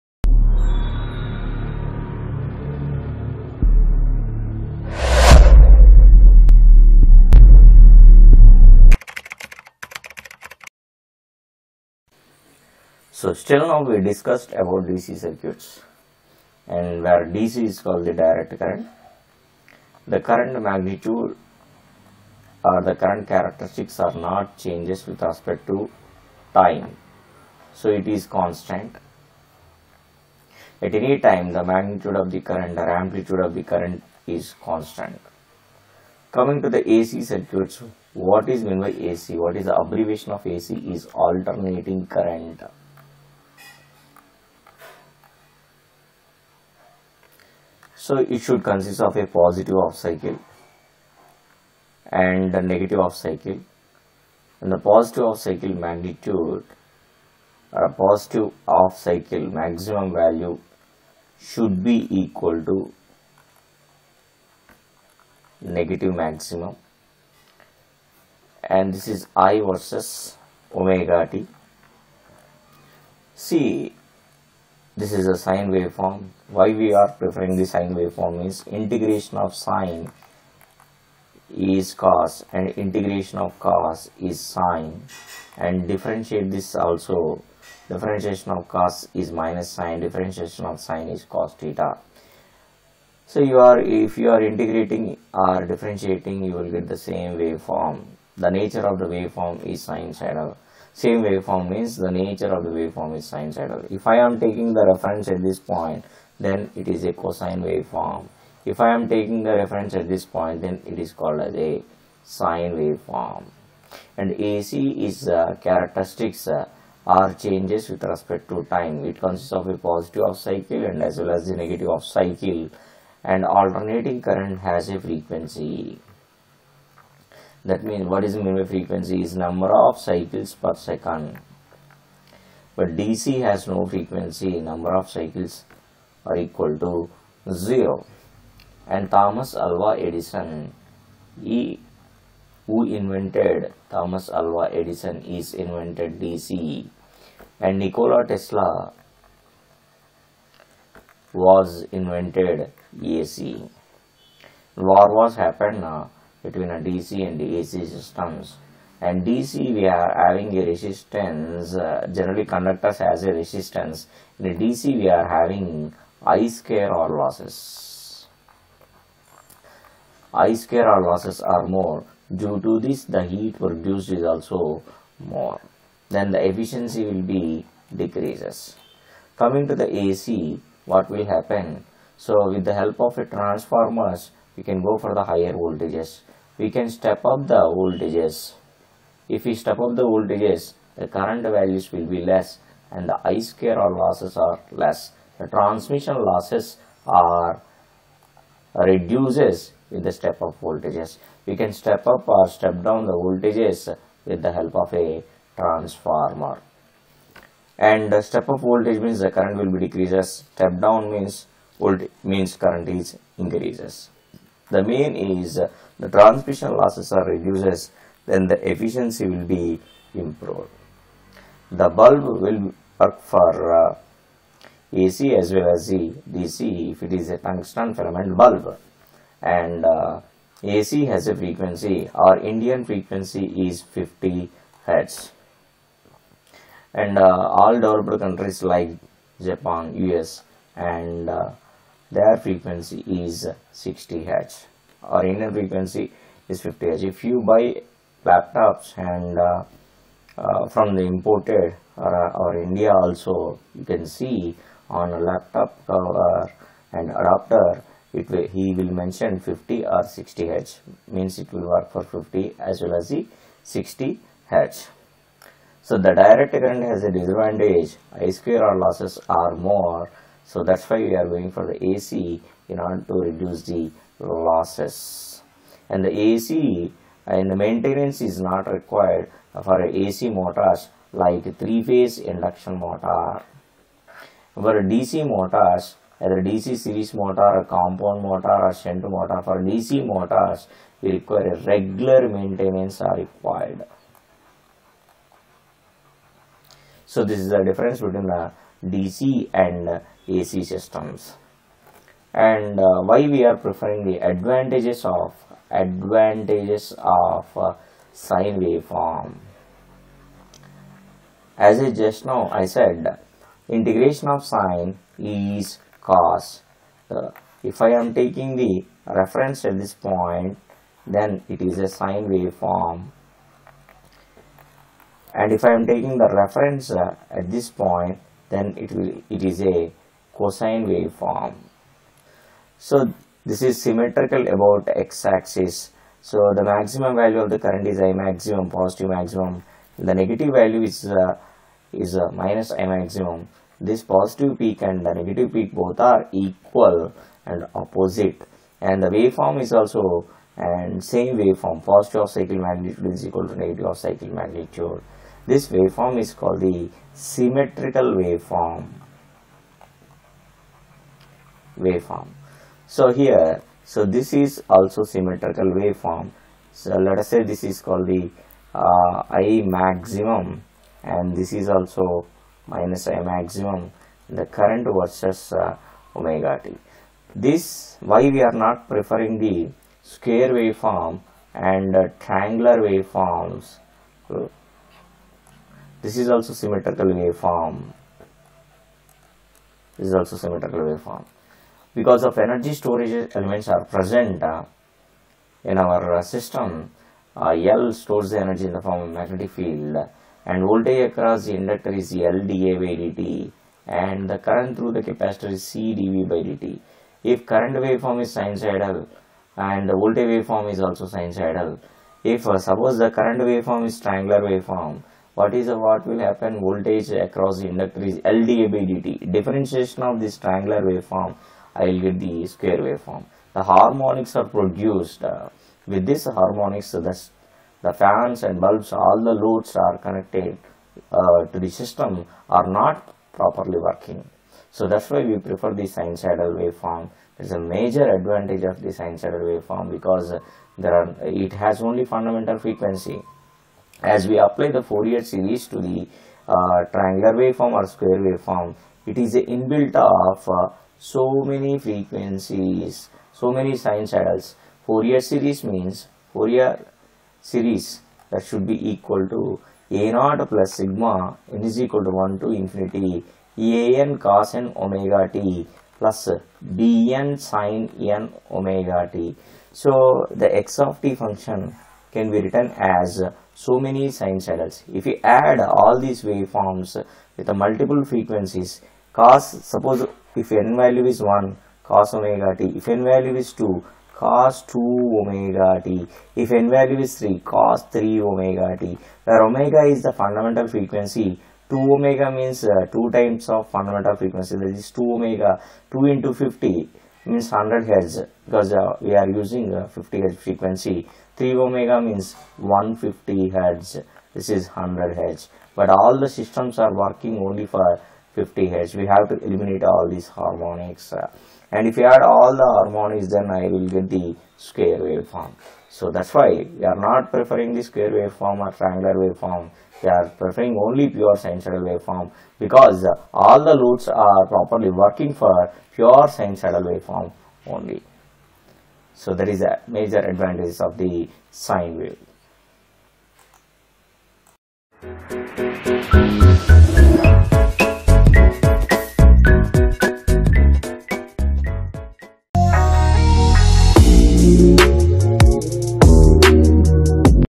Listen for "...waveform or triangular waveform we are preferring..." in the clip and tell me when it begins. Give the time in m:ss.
8:38.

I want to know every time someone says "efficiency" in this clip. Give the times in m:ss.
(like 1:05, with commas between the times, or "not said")
2:56, 3:38.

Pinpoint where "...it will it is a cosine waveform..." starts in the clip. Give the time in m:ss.
5:28.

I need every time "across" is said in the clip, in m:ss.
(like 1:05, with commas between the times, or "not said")
6:41, 6:57.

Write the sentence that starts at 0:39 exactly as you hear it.
What is the abbreviation of AC is alternating current.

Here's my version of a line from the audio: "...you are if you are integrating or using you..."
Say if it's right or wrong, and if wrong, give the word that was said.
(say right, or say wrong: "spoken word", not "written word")
wrong: "differentiating", not "using".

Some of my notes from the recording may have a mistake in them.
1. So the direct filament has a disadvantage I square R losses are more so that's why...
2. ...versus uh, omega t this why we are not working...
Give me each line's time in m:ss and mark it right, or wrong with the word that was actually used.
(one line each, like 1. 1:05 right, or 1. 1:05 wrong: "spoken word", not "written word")
1. 4:25 wrong: "current", not "filament"
2. 6:14 wrong: "preferring", not "working".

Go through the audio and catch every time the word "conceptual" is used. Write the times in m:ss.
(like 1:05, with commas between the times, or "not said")
not said.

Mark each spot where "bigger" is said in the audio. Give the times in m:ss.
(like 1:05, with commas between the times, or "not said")
not said.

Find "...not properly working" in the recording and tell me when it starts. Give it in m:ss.
7:12.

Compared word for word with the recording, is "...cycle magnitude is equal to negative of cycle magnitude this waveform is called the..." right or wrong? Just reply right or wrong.
right.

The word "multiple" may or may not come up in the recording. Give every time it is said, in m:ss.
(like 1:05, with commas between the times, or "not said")
7:57.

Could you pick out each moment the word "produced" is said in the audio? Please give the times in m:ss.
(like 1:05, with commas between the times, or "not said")
2:53, 7:04.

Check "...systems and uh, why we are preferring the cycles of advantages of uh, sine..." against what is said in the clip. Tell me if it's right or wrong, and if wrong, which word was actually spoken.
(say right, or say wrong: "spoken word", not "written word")
wrong: "advantages", not "cycles".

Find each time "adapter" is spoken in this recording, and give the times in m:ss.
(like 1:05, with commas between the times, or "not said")
4:17.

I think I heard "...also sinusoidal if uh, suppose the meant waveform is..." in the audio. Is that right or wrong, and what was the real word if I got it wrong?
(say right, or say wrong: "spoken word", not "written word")
wrong: "current", not "meant".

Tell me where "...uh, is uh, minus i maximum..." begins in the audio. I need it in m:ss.
5:41.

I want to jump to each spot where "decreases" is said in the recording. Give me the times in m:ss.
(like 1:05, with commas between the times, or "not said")
2:57, 3:29.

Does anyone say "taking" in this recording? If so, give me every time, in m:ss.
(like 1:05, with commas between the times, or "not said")
1:44, 1:49, 5:18, 5:25.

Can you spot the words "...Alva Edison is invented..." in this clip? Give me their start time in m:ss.
2:24.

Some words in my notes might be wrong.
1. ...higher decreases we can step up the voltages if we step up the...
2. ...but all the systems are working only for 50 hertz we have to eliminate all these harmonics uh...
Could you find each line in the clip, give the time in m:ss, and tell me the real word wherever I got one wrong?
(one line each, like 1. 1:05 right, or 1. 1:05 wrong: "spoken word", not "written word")
1. 3:05 wrong: "voltages", not "decreases"
2. 8:25 right.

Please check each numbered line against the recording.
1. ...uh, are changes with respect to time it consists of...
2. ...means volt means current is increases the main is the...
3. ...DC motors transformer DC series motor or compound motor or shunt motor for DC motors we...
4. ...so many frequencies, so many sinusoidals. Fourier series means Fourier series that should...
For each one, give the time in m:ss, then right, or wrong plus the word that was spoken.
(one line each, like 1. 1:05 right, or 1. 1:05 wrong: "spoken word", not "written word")
1. 1:56 right
2. 3:31 right
3. 4:44 wrong: "either", not "transformer"
4. 7:31 right.